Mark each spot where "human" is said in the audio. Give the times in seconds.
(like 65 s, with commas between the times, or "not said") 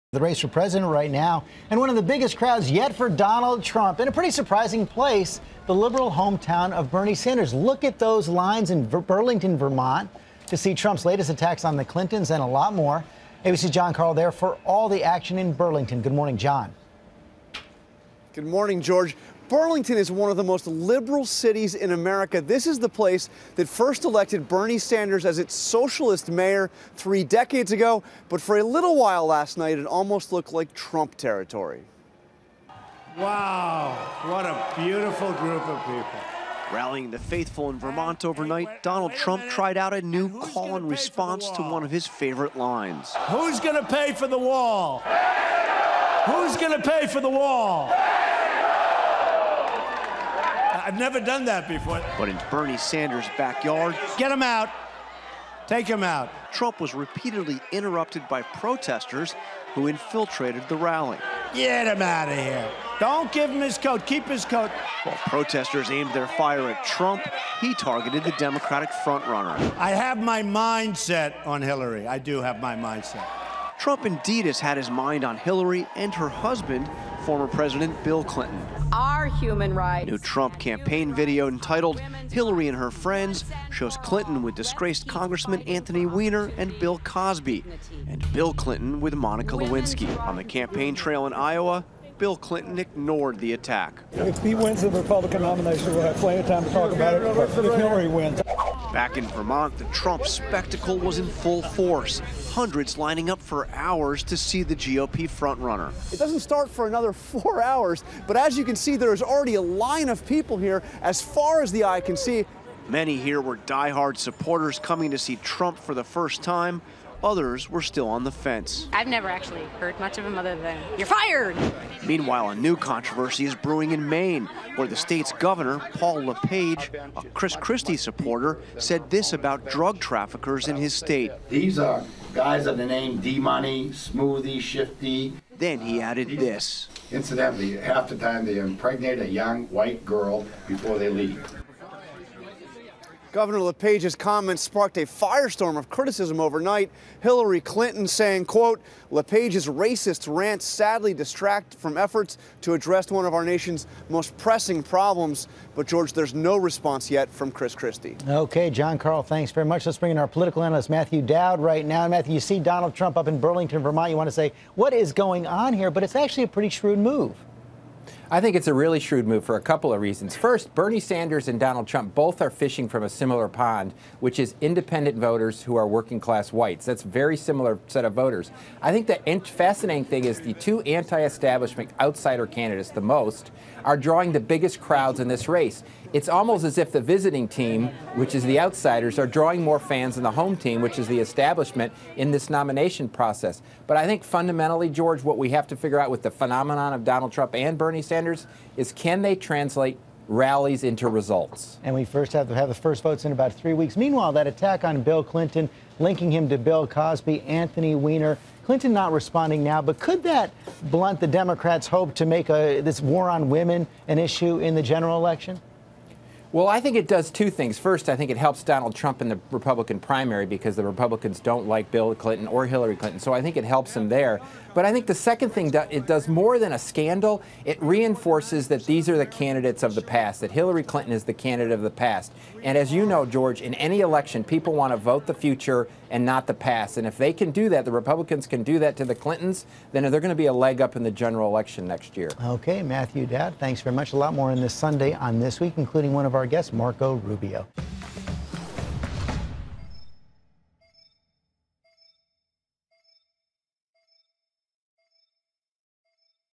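79 s.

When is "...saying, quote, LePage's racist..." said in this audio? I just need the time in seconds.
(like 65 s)
148 s.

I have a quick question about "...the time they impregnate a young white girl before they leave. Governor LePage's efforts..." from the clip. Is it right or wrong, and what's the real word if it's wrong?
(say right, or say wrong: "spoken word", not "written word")
wrong: "comments", not "efforts".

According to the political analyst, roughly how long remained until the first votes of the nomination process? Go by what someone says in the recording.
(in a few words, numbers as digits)
about 3 weeks.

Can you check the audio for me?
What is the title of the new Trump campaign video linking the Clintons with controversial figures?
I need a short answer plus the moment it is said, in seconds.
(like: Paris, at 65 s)
Hillary and Her Friends, at 82 s.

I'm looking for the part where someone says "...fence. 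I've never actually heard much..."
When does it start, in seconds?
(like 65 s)
118 s.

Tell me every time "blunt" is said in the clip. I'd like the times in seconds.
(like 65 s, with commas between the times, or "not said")
210 s.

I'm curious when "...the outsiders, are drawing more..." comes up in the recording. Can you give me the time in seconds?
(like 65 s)
188 s.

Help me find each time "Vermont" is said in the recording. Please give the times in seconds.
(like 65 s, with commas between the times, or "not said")
9 s, 37 s, 99 s, 163 s.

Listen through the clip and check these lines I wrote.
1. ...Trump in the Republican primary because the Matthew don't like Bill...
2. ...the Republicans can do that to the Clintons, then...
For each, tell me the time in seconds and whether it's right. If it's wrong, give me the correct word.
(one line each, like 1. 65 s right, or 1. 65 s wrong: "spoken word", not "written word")
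1. 218 s wrong: "Republicans", not "Matthew"
2. 237 s right.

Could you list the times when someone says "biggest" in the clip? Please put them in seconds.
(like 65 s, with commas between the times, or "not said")
2 s, 184 s.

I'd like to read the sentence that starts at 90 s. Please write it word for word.
On the campaign trail in Iowa, Bill Clinton ignored the attack.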